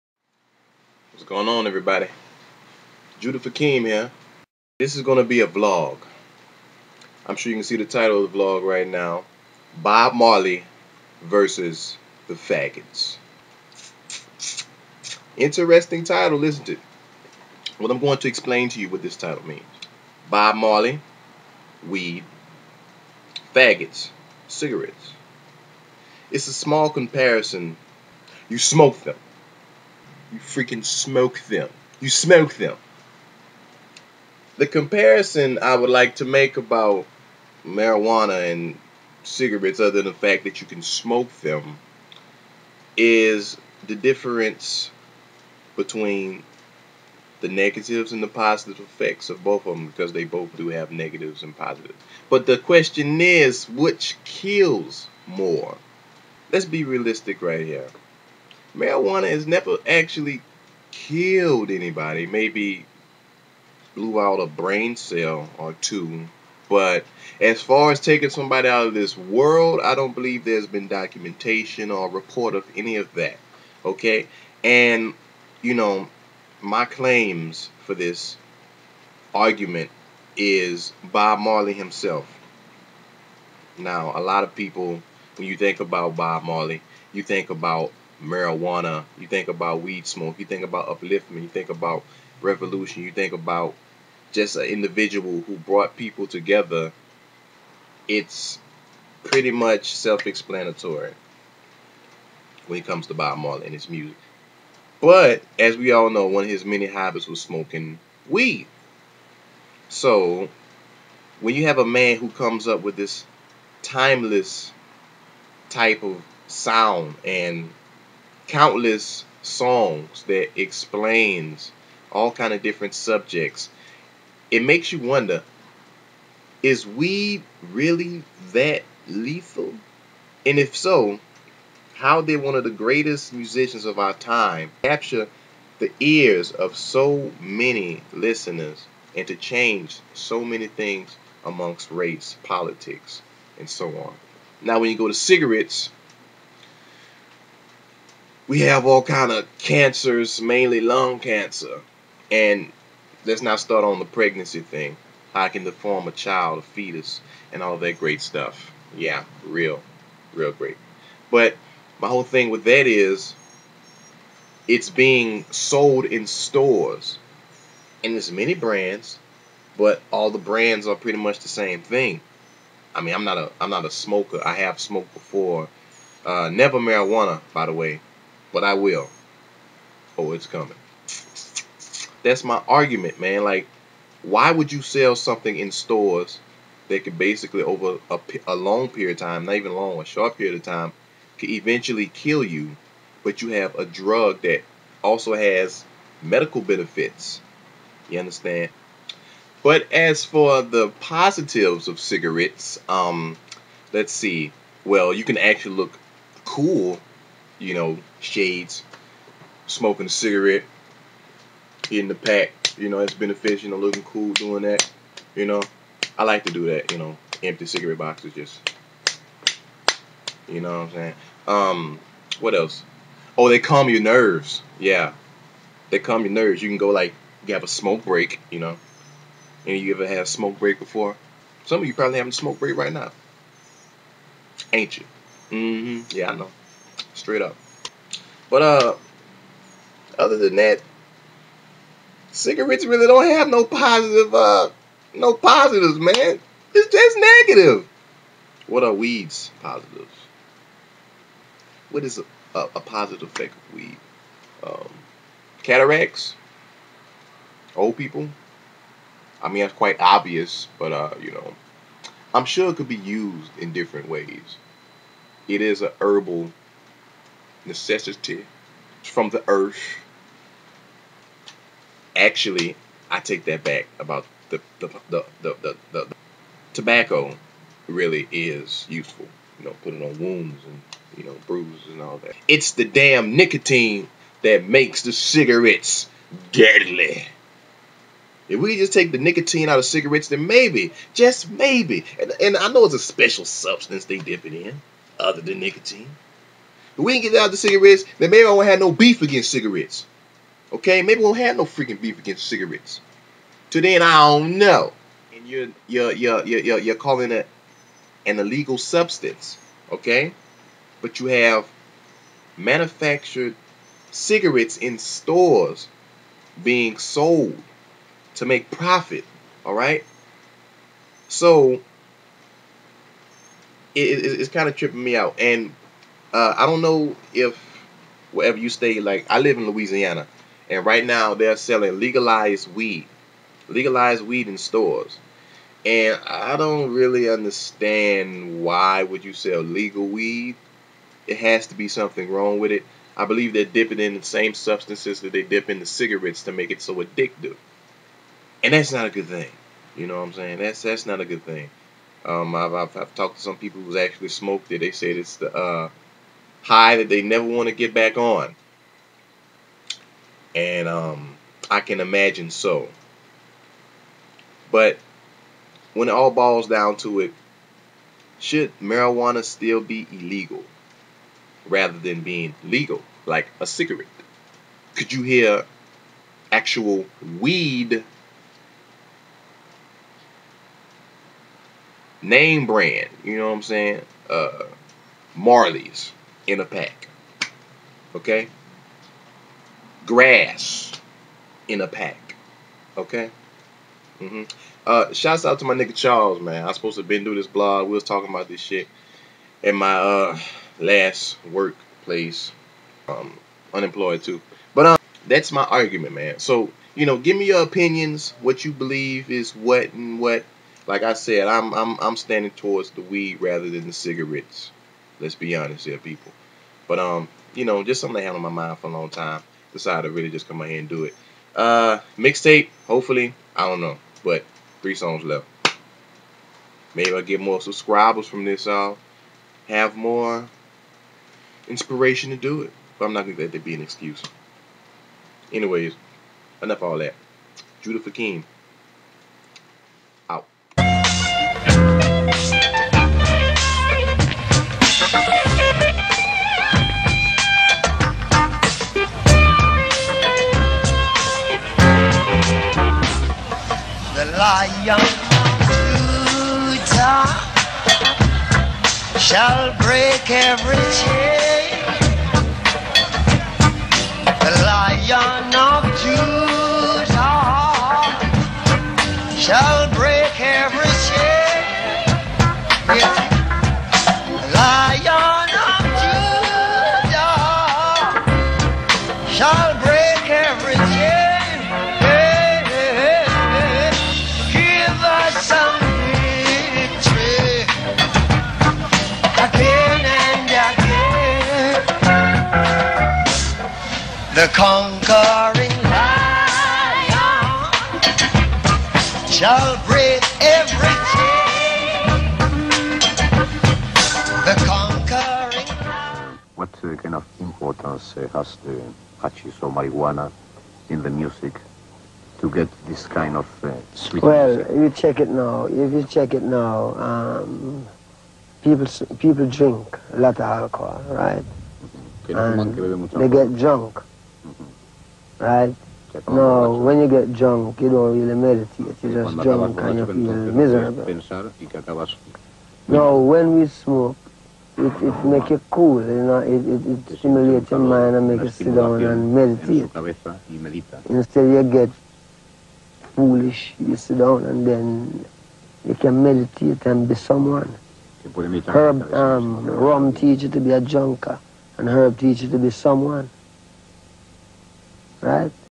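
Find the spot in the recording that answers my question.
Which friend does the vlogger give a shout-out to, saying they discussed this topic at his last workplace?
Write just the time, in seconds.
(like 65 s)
395 s.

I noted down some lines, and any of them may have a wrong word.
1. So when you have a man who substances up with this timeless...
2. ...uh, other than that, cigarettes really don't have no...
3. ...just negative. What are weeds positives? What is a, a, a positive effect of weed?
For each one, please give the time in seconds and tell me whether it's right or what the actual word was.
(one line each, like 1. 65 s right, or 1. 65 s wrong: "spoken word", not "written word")
1. 109 s wrong: "comes", not "substances"
2. 238 s right
3. 246 s right.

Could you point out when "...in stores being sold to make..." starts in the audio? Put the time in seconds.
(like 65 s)
314 s.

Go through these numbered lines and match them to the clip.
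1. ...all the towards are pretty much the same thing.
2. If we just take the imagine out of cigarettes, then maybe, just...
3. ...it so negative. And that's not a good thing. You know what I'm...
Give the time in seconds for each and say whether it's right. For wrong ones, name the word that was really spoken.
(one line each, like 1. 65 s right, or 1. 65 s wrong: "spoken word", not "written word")
1. 170 s wrong: "brands", not "towards"
2. 288 s wrong: "nicotine", not "imagine"
3. 346 s wrong: "addictive", not "negative".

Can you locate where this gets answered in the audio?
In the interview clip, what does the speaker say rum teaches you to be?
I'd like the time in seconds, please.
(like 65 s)
550 s.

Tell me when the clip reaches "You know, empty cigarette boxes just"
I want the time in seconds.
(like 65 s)
216 s.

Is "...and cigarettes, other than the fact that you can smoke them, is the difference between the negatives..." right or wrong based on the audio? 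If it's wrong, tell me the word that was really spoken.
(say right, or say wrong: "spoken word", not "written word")
right.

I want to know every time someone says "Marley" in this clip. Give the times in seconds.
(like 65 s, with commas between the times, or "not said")
10 s, 20 s, 81 s, 86 s, 103 s, 385 s.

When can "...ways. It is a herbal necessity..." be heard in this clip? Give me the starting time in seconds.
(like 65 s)
264 s.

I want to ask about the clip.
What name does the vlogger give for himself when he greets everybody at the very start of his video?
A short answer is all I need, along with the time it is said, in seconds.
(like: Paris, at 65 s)
Judah Fakim, at 3 s.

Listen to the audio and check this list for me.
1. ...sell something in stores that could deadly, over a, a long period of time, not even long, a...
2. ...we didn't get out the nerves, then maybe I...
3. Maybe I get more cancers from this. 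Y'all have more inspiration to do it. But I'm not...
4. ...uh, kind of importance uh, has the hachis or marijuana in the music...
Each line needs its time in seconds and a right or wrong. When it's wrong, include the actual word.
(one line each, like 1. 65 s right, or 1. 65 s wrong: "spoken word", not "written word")
1. 184 s wrong: "basically", not "deadly"
2. 297 s wrong: "cigarettes", not "nerves"
3. 426 s wrong: "subscribers", not "cancers"
4. 506 s right.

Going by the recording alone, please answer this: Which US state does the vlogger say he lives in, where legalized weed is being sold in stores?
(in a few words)
Louisiana.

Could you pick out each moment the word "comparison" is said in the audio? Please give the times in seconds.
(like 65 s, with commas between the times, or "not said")
26 s, 34 s.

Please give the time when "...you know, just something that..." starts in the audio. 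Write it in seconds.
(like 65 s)
417 s.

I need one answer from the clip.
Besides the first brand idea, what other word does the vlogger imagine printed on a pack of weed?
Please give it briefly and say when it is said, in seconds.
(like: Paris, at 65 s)
Grass, at 390 s.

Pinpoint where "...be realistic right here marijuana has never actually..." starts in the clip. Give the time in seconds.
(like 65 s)
56 s.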